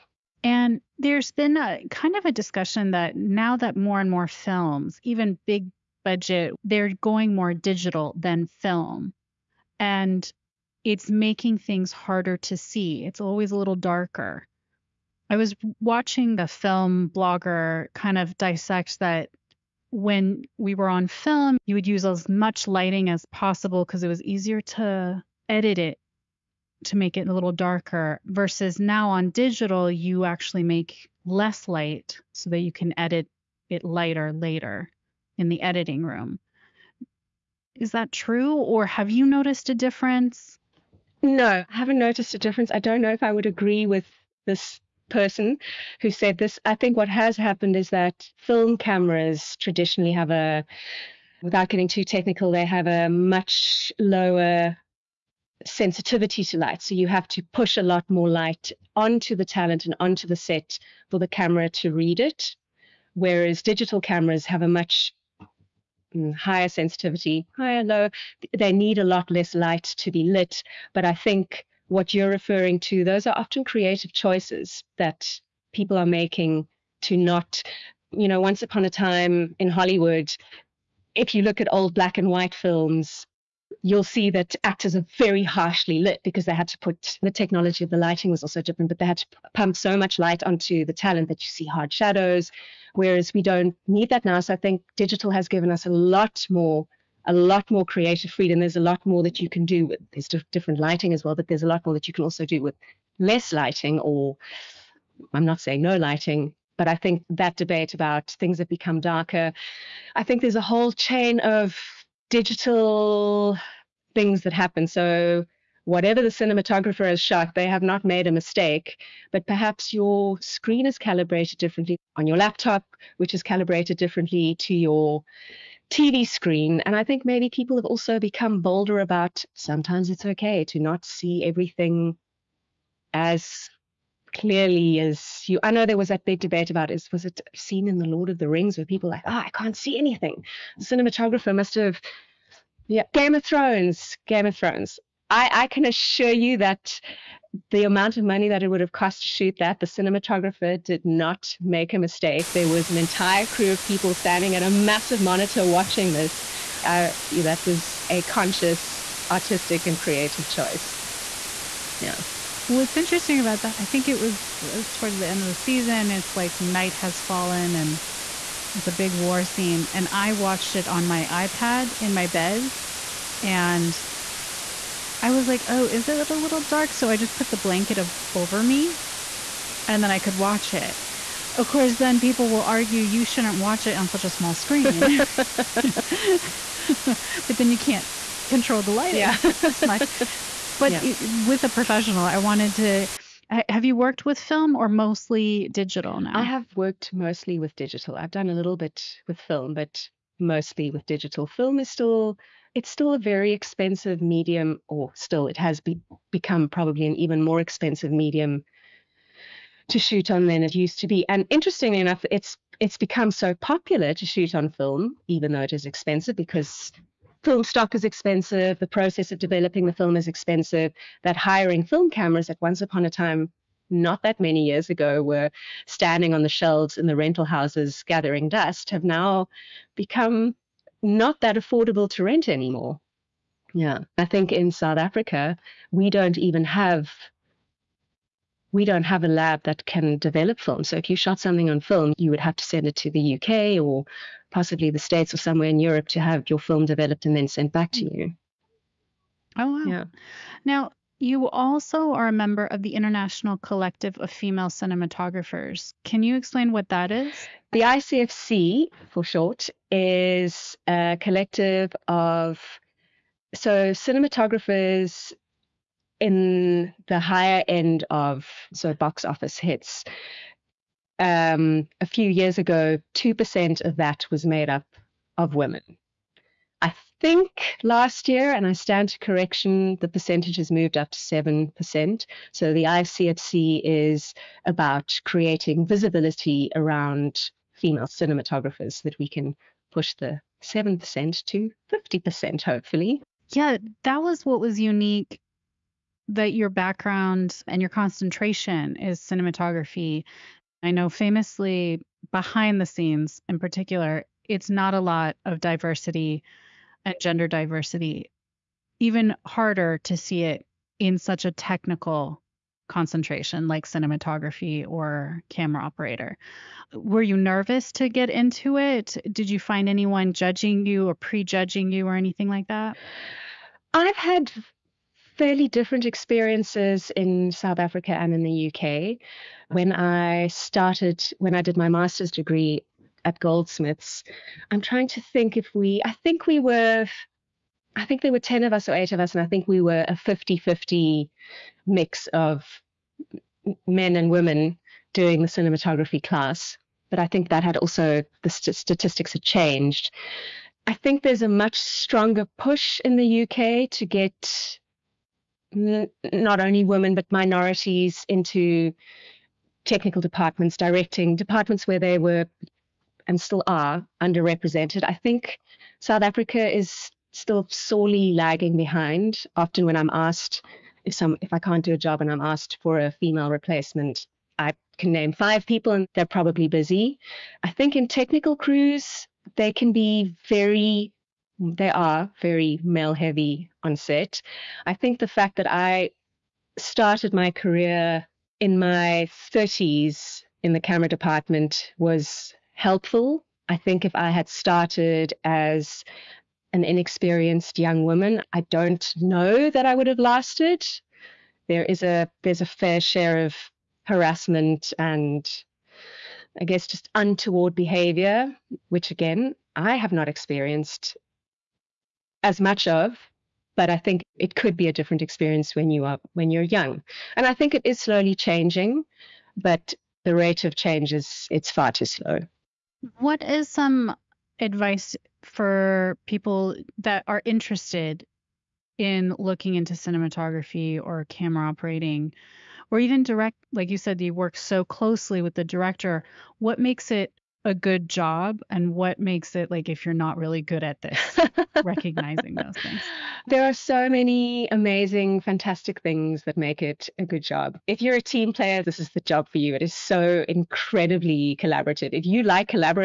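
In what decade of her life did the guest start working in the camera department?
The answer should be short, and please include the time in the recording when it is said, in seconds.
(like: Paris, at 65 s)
30s, at 389 s.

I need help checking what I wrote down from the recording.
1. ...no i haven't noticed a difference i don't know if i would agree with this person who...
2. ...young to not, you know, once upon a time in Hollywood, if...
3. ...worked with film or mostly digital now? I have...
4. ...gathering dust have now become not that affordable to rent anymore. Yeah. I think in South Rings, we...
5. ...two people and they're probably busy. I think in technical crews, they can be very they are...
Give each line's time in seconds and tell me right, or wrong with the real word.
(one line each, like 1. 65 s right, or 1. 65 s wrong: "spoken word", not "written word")
1. 41 s right
2. 76 s wrong: "making", not "young"
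3. 193 s right
4. 228 s wrong: "Africa", not "Rings"
5. 375 s wrong: "five", not "two".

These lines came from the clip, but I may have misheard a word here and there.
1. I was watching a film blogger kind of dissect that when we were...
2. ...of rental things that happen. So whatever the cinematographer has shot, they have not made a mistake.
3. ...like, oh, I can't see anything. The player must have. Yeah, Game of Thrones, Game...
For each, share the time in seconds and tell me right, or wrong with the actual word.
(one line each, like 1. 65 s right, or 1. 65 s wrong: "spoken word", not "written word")
1. 15 s right
2. 111 s wrong: "digital", not "rental"
3. 139 s wrong: "cinematographer", not "player".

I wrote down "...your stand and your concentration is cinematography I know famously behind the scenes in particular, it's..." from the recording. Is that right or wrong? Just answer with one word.
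wrong.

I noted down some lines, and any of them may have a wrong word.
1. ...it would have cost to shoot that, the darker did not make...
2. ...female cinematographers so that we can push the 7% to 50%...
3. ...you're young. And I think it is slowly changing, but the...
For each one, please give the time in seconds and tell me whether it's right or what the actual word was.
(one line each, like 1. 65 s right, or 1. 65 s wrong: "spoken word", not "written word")
1. 148 s wrong: "cinematographer", not "darker"
2. 287 s right
3. 416 s right.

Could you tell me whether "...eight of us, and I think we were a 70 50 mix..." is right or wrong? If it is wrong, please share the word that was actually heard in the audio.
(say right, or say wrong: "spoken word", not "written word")
wrong: "50", not "70".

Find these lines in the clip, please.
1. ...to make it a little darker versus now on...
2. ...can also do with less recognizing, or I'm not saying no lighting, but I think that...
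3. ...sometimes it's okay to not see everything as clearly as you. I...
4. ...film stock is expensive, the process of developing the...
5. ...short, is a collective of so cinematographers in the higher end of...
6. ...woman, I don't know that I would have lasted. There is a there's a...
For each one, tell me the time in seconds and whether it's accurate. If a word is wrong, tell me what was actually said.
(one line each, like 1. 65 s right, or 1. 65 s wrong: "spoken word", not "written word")
1. 26 s right
2. 102 s wrong: "lighting", not "recognizing"
3. 129 s right
4. 217 s right
5. 259 s right
6. 398 s right.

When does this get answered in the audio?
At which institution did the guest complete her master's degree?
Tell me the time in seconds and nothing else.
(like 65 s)
333 s.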